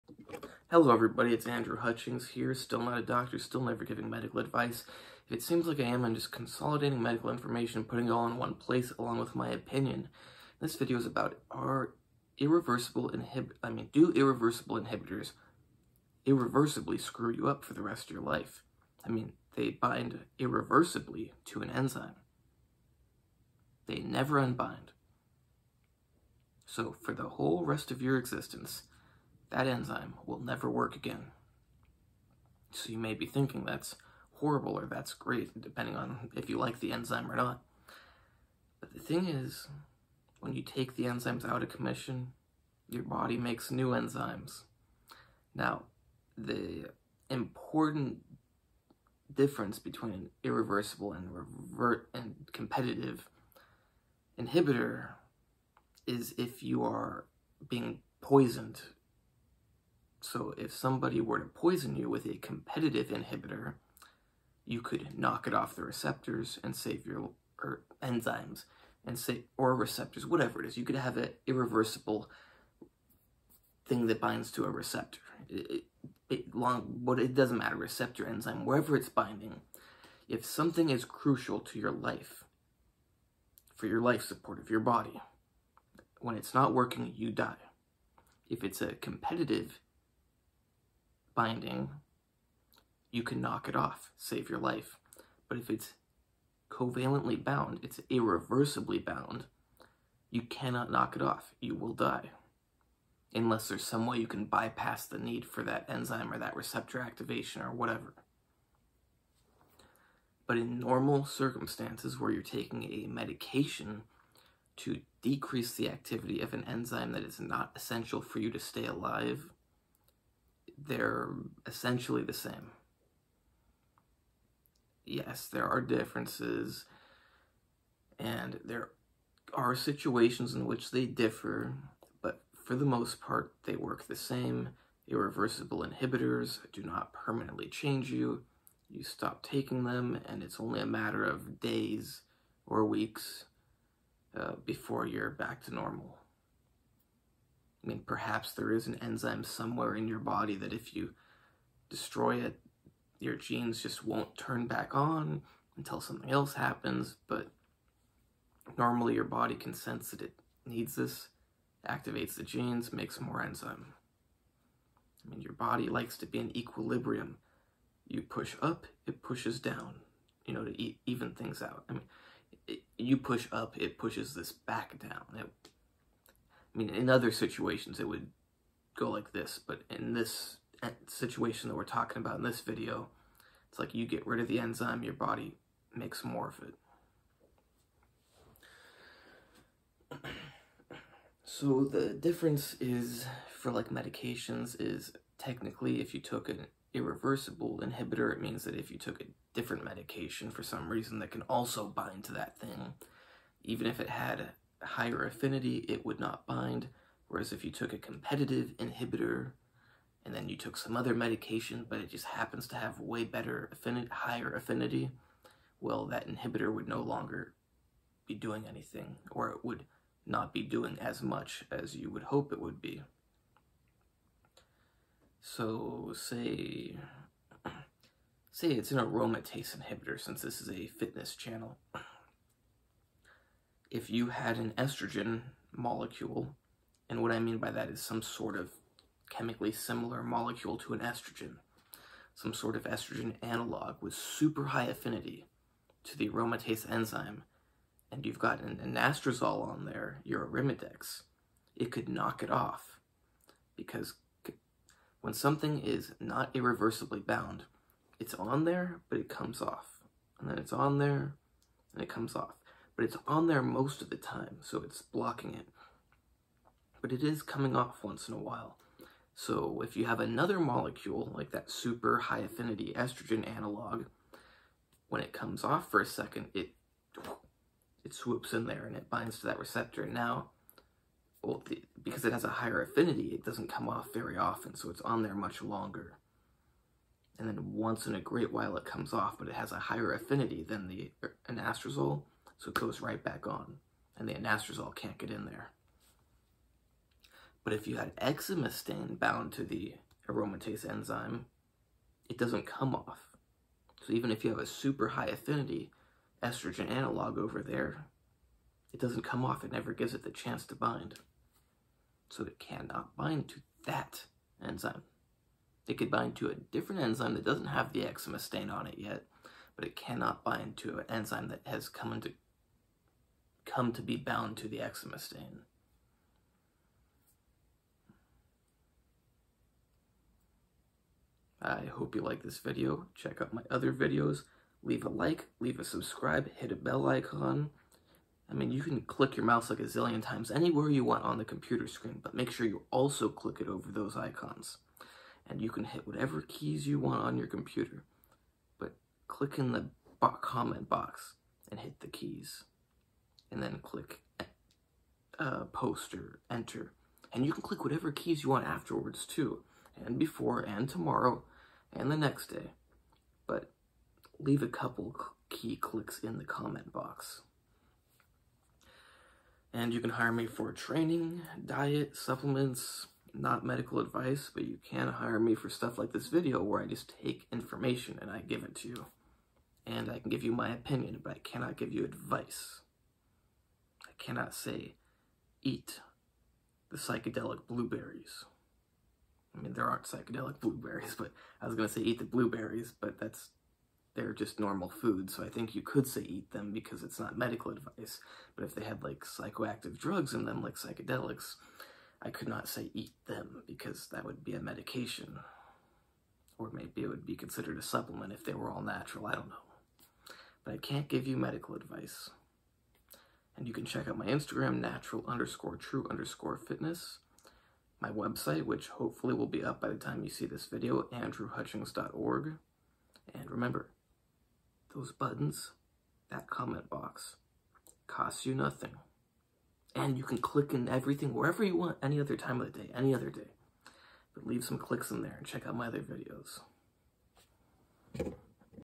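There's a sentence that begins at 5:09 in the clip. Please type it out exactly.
It never gives it the chance to bind.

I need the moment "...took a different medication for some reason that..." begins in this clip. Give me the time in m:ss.
3:18.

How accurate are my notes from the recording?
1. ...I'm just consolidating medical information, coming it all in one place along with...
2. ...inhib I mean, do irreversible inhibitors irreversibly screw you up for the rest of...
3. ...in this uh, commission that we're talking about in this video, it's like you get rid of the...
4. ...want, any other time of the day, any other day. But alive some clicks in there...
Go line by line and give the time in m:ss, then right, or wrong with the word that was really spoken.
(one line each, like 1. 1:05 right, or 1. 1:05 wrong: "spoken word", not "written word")
1. 0:06 wrong: "putting", not "coming"
2. 0:13 right
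3. 2:59 wrong: "situation", not "commission"
4. 7:11 wrong: "leave", not "alive".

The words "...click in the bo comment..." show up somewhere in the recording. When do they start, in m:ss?
5:49.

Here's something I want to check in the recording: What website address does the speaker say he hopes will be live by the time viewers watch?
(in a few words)
andrewhutchings.org.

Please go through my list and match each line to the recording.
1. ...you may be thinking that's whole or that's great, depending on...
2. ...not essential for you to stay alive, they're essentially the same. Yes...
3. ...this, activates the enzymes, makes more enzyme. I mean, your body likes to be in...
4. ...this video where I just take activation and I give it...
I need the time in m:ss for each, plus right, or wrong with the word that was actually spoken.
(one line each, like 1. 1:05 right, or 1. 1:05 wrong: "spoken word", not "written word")
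1. 0:32 wrong: "horrible", not "whole"
2. 1:57 right
3. 2:40 wrong: "genes", not "enzymes"
4. 6:16 wrong: "information", not "activation".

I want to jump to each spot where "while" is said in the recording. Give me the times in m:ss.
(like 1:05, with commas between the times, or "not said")
4:28, 4:48.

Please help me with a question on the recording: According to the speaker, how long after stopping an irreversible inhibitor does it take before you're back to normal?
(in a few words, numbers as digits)
days or weeks.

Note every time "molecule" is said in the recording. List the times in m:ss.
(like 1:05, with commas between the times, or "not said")
3:55, 4:00, 4:30.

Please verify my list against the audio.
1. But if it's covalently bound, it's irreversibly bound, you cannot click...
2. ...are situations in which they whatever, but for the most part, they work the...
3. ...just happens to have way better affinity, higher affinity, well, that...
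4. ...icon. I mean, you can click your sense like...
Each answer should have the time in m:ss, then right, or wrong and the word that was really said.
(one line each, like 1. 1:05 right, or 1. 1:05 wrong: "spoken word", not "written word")
1. 1:35 wrong: "knock", not "click"
2. 2:09 wrong: "differ", not "whatever"
3. 3:32 right
4. 5:37 wrong: "mouse", not "sense".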